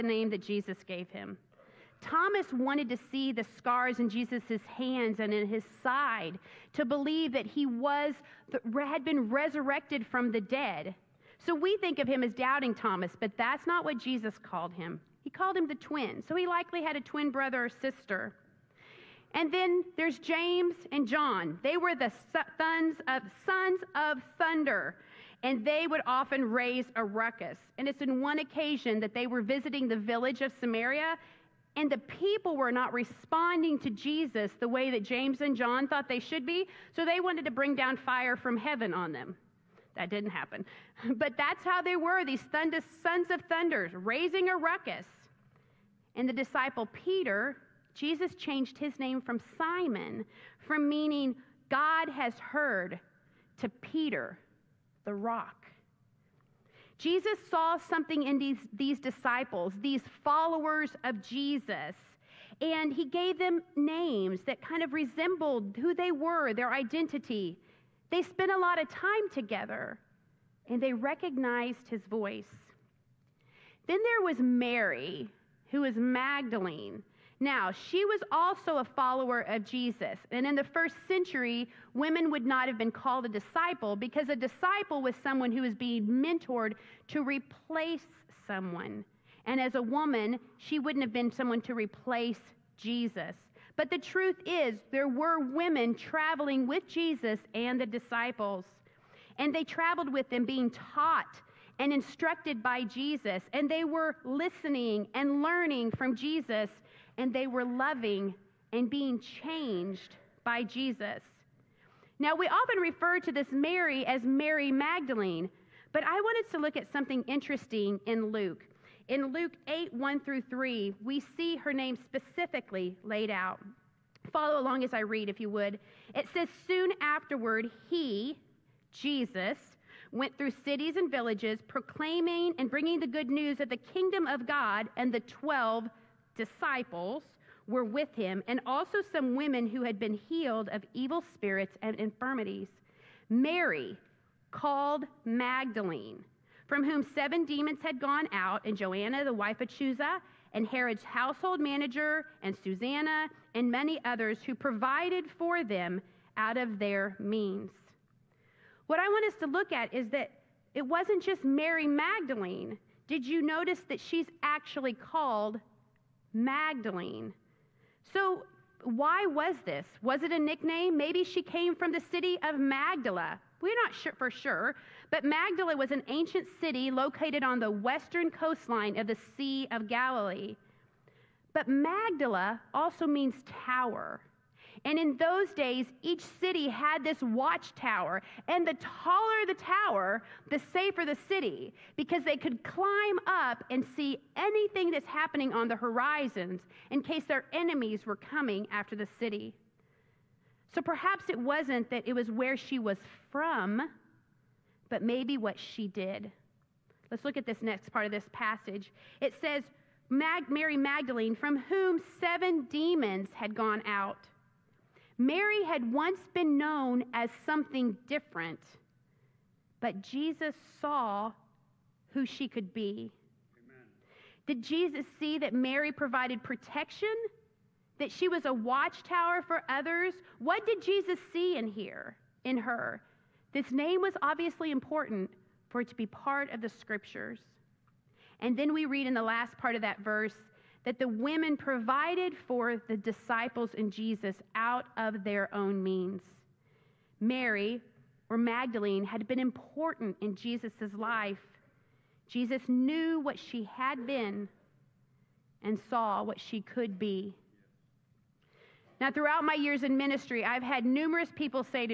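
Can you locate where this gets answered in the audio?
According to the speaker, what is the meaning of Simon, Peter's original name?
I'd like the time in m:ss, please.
0:51.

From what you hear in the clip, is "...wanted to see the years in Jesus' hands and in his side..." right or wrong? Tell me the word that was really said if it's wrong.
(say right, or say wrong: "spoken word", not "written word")
wrong: "scars", not "years".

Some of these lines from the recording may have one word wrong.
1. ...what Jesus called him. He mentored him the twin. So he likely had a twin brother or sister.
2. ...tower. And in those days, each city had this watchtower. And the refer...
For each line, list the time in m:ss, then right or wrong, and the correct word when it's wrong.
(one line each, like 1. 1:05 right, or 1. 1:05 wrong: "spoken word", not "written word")
1. 0:13 wrong: "called", not "mentored"
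2. 3:03 wrong: "taller", not "refer".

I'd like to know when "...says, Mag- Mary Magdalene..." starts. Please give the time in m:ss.
3:29.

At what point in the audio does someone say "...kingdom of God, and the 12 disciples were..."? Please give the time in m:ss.
2:13.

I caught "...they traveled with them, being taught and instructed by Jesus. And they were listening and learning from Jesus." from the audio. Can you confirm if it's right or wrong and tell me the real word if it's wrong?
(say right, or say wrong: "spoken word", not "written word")
right.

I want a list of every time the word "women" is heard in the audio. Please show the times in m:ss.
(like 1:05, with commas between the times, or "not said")
1:21, 1:35, 2:19, 4:01.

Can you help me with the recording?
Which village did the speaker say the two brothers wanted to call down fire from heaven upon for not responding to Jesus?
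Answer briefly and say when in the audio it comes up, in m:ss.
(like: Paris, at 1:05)
Samaria, at 0:30.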